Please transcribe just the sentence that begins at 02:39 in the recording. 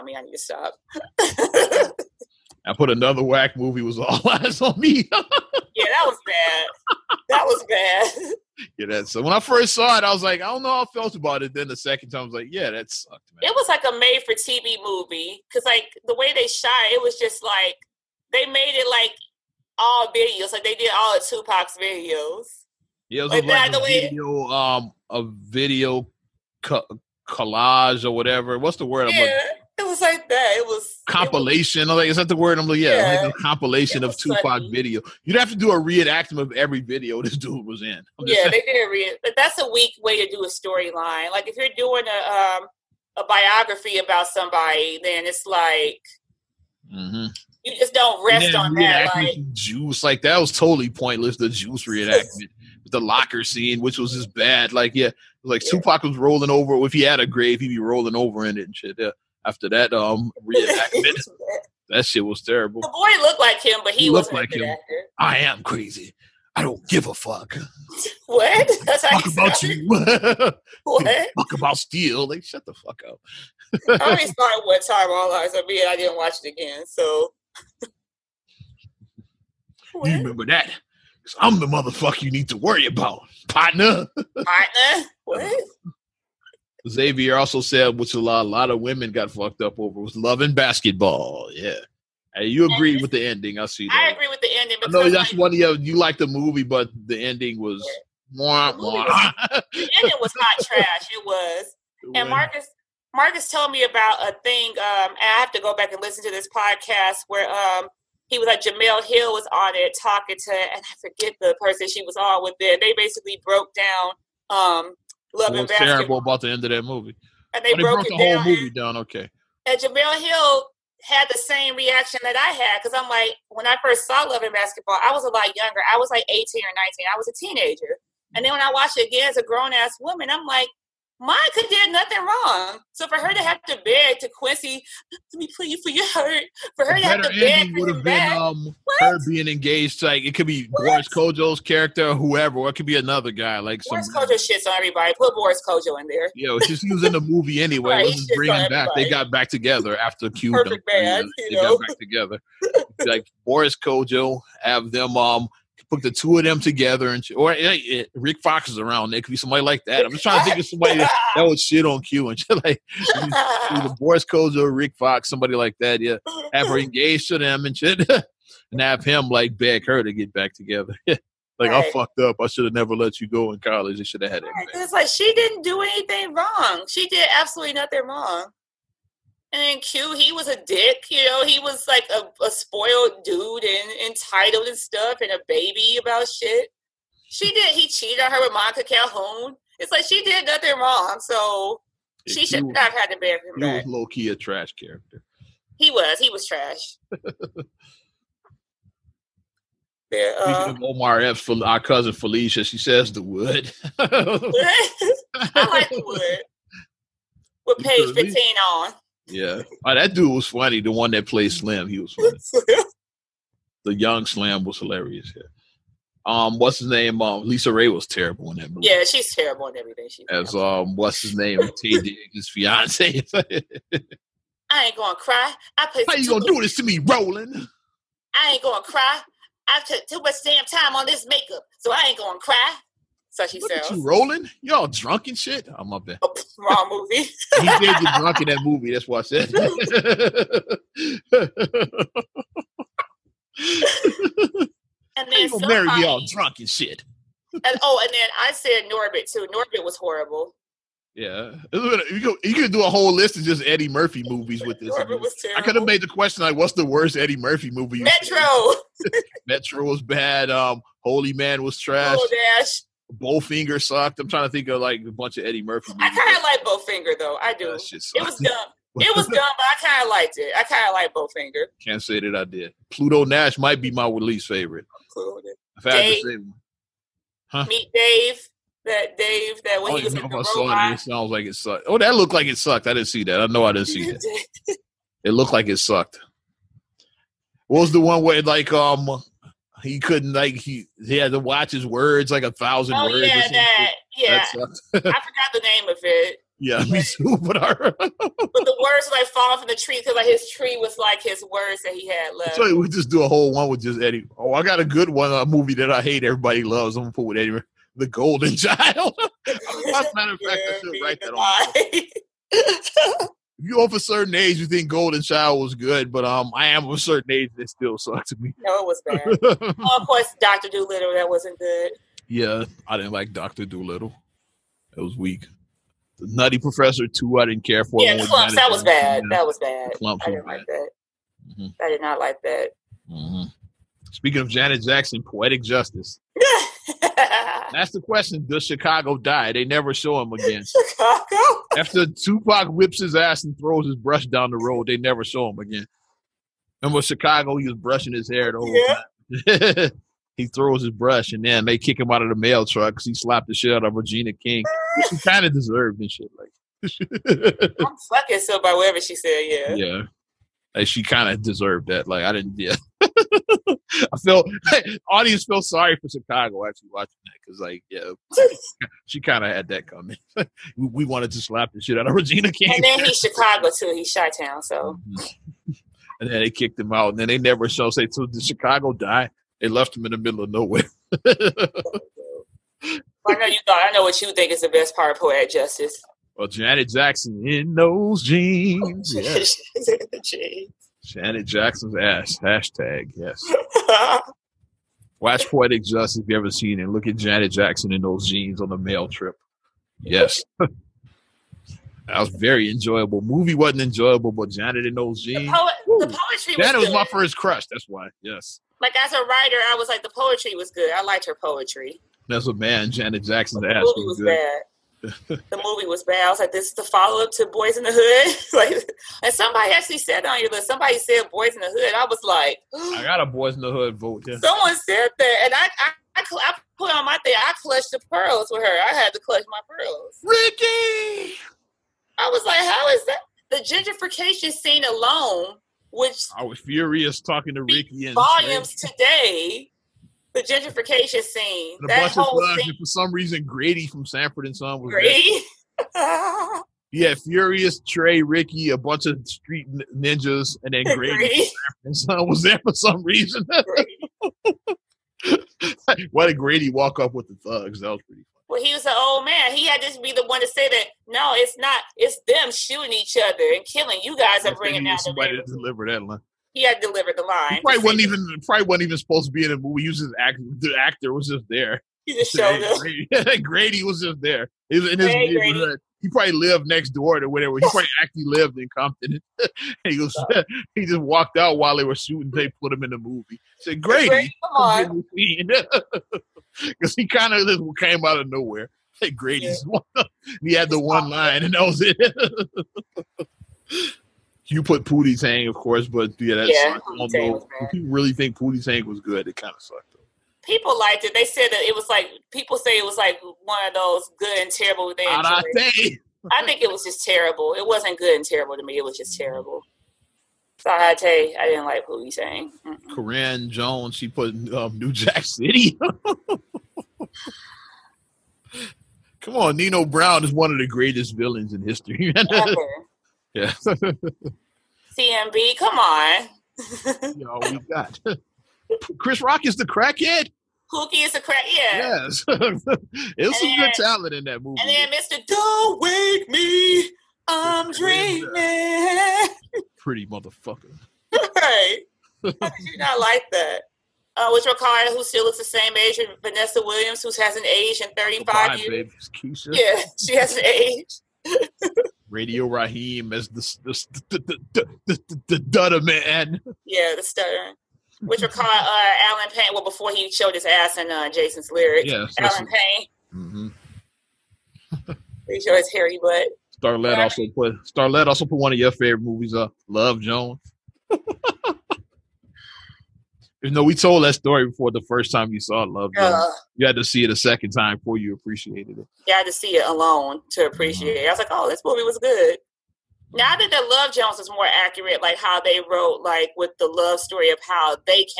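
There could be somebody like that.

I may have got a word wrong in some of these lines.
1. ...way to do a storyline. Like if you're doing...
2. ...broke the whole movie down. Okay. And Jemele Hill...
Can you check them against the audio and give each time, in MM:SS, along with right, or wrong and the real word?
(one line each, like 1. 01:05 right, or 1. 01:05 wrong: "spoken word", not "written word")
1. 00:40 right
2. 01:58 right.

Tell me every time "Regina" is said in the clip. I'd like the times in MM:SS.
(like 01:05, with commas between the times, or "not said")
05:53, 06:12.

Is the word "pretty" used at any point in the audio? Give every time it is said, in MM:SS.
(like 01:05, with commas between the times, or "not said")
07:38, 08:59.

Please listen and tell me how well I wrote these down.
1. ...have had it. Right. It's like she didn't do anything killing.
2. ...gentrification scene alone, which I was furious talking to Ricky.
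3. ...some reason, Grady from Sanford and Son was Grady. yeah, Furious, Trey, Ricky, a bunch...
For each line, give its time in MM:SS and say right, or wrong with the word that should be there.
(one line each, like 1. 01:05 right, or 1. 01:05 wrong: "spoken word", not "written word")
1. 02:54 wrong: "wrong", not "killing"
2. 07:13 right
3. 07:22 right.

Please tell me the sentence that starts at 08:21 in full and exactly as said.
They said that it was like people say it was like one of those good and terrible.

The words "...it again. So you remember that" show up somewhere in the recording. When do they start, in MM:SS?
01:16.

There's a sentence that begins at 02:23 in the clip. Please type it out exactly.
Like Boris some, Kodjoe shits on everybody.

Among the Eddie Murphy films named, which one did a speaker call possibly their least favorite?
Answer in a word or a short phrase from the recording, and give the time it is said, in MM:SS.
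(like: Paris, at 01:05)
Pluto Nash, at 04:32.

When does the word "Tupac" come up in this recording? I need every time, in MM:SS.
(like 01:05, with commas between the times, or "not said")
00:21, 00:34, 00:55, 05:42.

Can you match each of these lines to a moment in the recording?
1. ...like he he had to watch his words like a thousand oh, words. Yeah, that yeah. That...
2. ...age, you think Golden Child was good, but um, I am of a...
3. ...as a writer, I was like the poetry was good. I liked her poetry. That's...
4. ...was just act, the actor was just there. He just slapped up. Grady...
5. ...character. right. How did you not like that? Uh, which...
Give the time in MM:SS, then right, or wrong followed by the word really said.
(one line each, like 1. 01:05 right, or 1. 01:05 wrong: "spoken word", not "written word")
1. 04:50 right
2. 05:14 right
3. 06:49 right
4. 07:49 wrong: "showed", not "slapped"
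5. 09:00 wrong: "motherfucker", not "character".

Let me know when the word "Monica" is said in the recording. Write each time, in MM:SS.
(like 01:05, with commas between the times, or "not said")
02:11, 03:08.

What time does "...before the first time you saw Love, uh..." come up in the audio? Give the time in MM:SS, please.
09:34.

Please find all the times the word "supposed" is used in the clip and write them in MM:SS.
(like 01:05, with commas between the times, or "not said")
07:48.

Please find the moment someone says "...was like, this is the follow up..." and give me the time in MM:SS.
06:56.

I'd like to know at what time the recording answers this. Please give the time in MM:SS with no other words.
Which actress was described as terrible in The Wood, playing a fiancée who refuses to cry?
03:37.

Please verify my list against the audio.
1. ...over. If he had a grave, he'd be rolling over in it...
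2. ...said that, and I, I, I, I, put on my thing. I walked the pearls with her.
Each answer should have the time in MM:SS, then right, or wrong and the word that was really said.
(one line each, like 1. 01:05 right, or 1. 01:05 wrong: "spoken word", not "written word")
1. 00:56 right
2. 07:04 wrong: "clutched", not "walked".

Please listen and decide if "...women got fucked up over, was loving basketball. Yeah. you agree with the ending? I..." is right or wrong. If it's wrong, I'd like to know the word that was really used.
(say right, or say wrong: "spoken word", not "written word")
right.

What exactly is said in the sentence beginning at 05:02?
So we just do a whole one with just Eddie.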